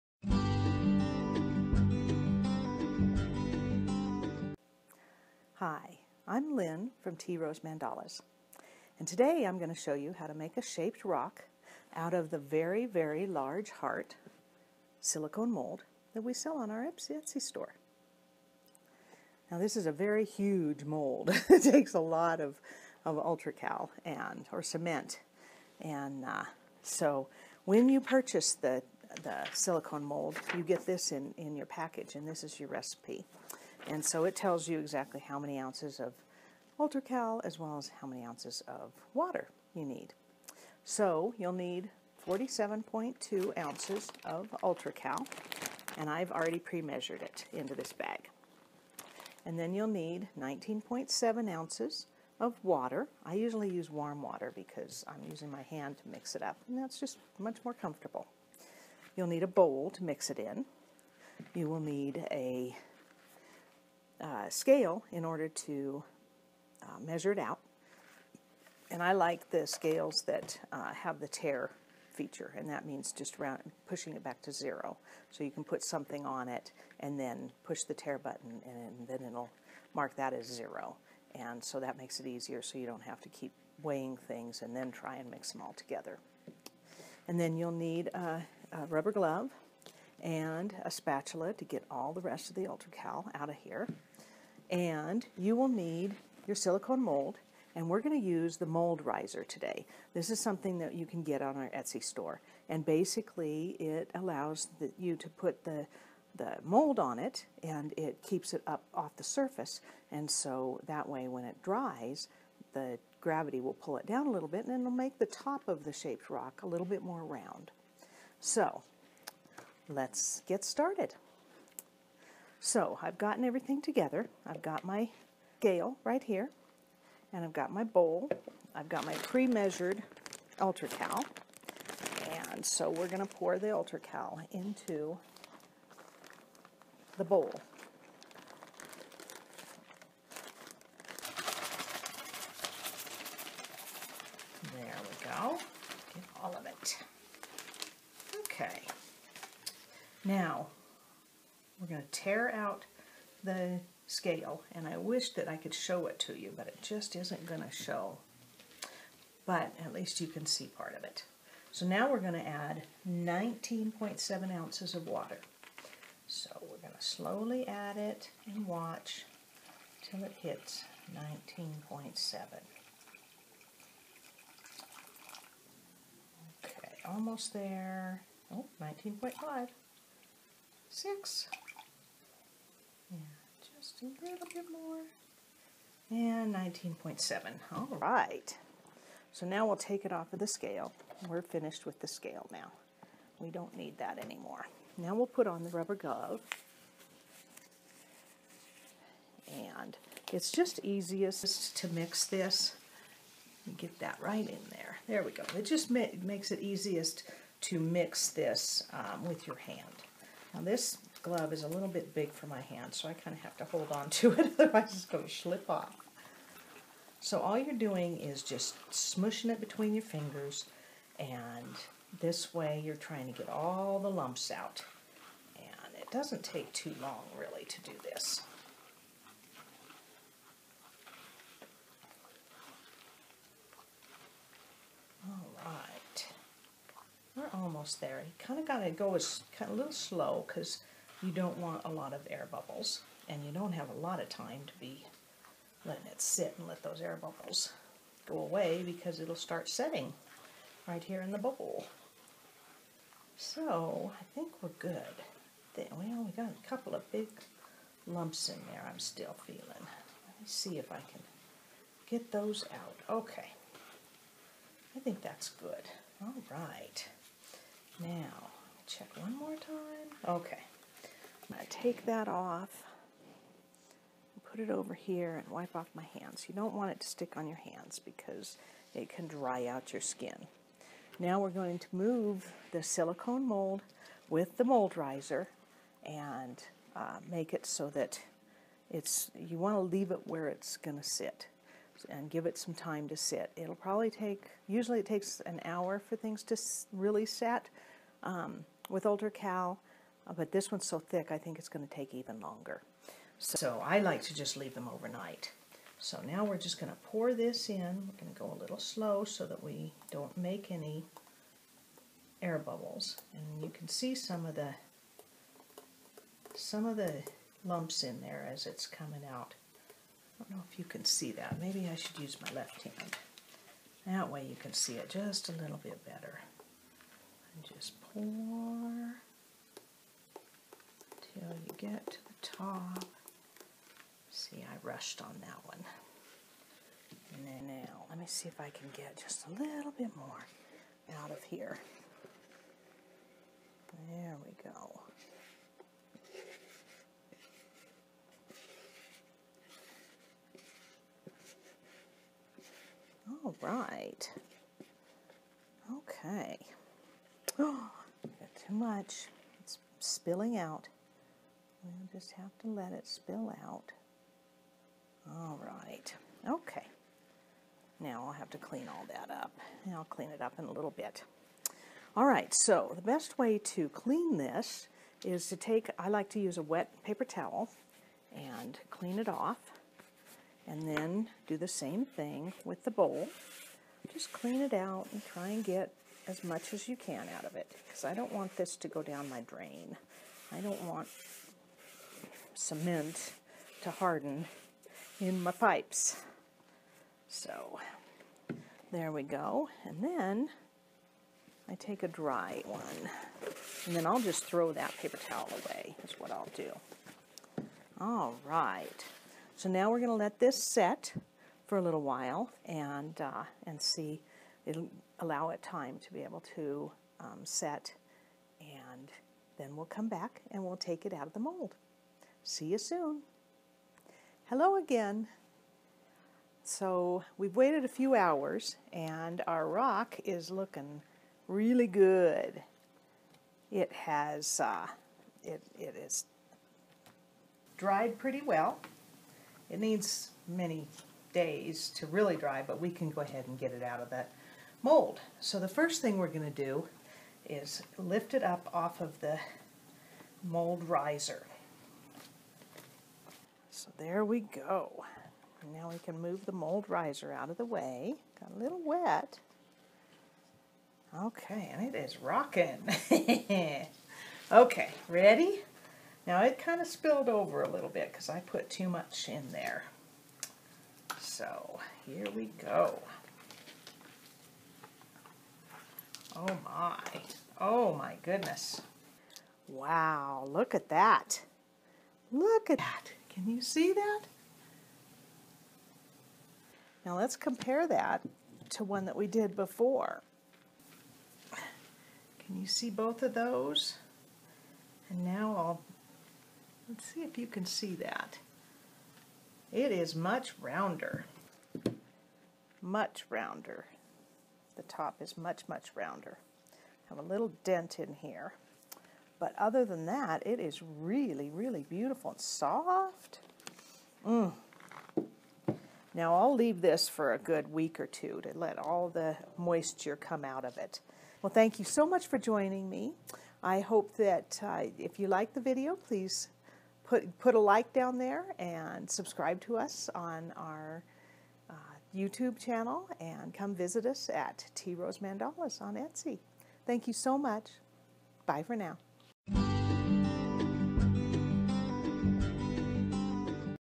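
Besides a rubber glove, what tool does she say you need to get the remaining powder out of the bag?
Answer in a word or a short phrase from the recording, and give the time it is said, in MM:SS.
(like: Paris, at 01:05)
spatula, at 01:30.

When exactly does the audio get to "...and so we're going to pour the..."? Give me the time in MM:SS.
02:12.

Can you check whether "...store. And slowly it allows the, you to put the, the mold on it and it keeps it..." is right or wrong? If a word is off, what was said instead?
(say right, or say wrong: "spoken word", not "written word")
wrong: "basically", not "slowly".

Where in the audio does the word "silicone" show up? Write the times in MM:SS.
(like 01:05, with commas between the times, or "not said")
00:15, 00:29, 01:36, 04:42.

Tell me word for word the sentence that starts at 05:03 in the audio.
So I like to just leave them overnight.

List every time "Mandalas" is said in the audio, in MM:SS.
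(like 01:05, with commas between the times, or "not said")
00:07, 08:55.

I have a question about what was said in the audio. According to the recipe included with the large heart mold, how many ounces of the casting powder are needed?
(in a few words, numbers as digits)
47.2 ounces.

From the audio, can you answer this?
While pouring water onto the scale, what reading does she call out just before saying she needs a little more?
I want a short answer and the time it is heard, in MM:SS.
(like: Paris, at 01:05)
19.5, at 02:58.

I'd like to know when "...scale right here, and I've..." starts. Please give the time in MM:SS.
02:05.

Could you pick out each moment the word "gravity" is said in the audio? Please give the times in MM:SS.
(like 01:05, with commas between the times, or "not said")
01:53.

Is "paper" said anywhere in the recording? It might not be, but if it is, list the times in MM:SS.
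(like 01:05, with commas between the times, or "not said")
06:17, 06:44.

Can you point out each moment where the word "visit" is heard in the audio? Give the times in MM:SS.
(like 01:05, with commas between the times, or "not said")
08:53.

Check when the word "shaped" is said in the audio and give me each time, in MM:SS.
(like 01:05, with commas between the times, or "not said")
00:10, 01:55.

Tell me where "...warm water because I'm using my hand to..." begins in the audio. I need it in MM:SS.
00:53.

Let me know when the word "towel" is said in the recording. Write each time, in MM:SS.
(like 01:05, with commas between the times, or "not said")
06:17, 06:45.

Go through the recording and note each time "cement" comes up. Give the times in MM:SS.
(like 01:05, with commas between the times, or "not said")
00:24, 06:32.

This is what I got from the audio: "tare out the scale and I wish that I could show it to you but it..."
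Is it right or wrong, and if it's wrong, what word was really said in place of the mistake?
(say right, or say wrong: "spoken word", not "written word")
right.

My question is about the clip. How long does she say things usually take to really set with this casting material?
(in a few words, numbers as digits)
an hour.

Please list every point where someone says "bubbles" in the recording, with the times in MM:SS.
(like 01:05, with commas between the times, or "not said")
04:02, 04:07, 05:12.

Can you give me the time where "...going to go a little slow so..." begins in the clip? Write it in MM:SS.
05:08.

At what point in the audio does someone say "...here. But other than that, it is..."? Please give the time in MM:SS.
08:28.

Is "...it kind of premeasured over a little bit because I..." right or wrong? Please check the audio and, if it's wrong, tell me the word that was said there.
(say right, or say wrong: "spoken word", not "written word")
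wrong: "spilled", not "premeasured".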